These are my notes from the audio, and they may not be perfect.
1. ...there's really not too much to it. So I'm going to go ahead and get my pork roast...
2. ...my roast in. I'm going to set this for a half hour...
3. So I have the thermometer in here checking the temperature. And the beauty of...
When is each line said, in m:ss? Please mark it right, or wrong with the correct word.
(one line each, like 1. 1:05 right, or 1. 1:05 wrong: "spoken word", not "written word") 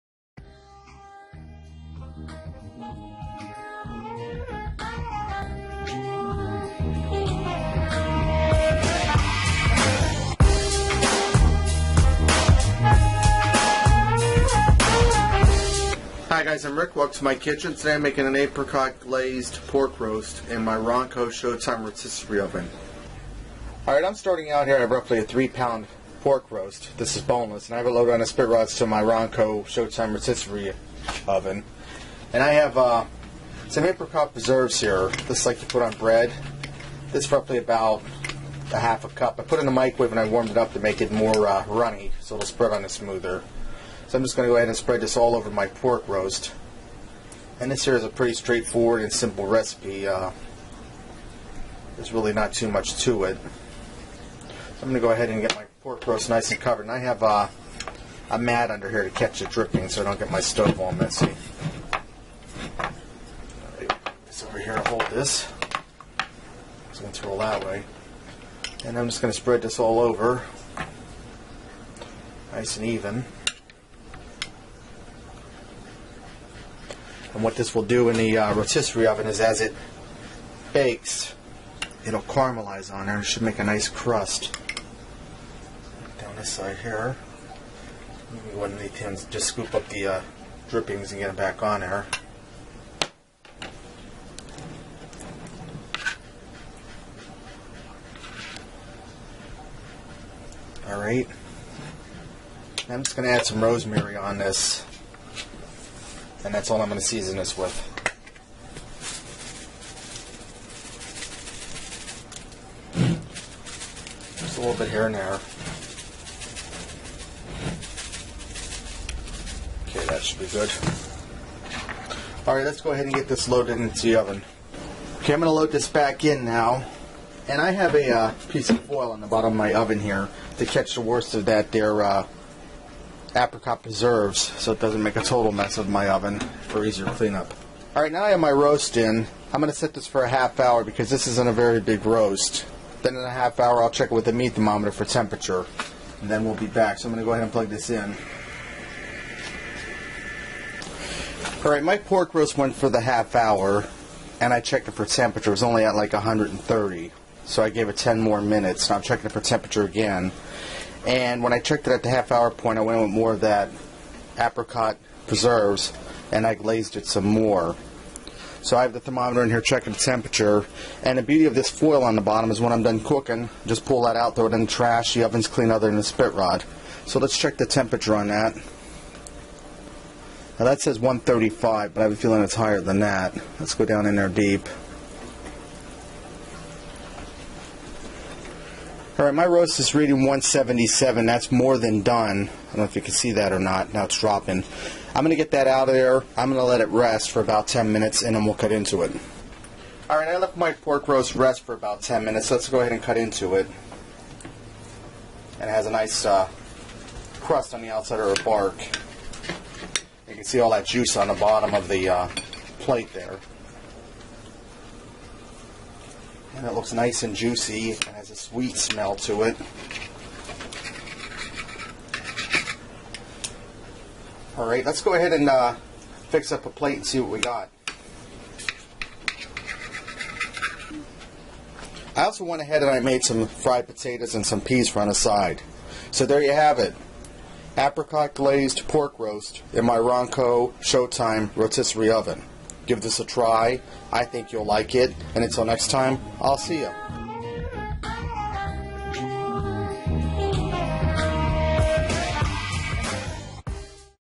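1. 0:51 right
2. 2:18 right
3. 2:48 right.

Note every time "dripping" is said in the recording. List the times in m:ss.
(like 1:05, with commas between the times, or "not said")
0:59, 1:30.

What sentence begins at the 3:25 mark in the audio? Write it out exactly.
And it has a nice uh, crust on the outside or a bark.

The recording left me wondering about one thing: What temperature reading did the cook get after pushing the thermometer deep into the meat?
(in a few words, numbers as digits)
177.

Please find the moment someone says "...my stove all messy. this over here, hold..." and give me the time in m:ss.
1:00.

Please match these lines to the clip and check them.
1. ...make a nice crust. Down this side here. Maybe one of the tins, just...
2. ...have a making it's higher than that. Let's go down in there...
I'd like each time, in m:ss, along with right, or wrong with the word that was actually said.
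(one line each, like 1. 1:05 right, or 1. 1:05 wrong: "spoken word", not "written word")
1. 1:23 right
2. 3:02 wrong: "feeling", not "making".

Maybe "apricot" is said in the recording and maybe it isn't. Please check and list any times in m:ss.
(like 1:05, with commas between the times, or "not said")
0:18, 0:33, 2:13, 2:44, 3:57.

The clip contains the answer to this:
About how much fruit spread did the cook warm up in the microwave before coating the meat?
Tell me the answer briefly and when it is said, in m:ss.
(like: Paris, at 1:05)
half a cup, at 0:38.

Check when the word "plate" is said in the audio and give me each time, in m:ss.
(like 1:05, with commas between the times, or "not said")
3:32, 3:46.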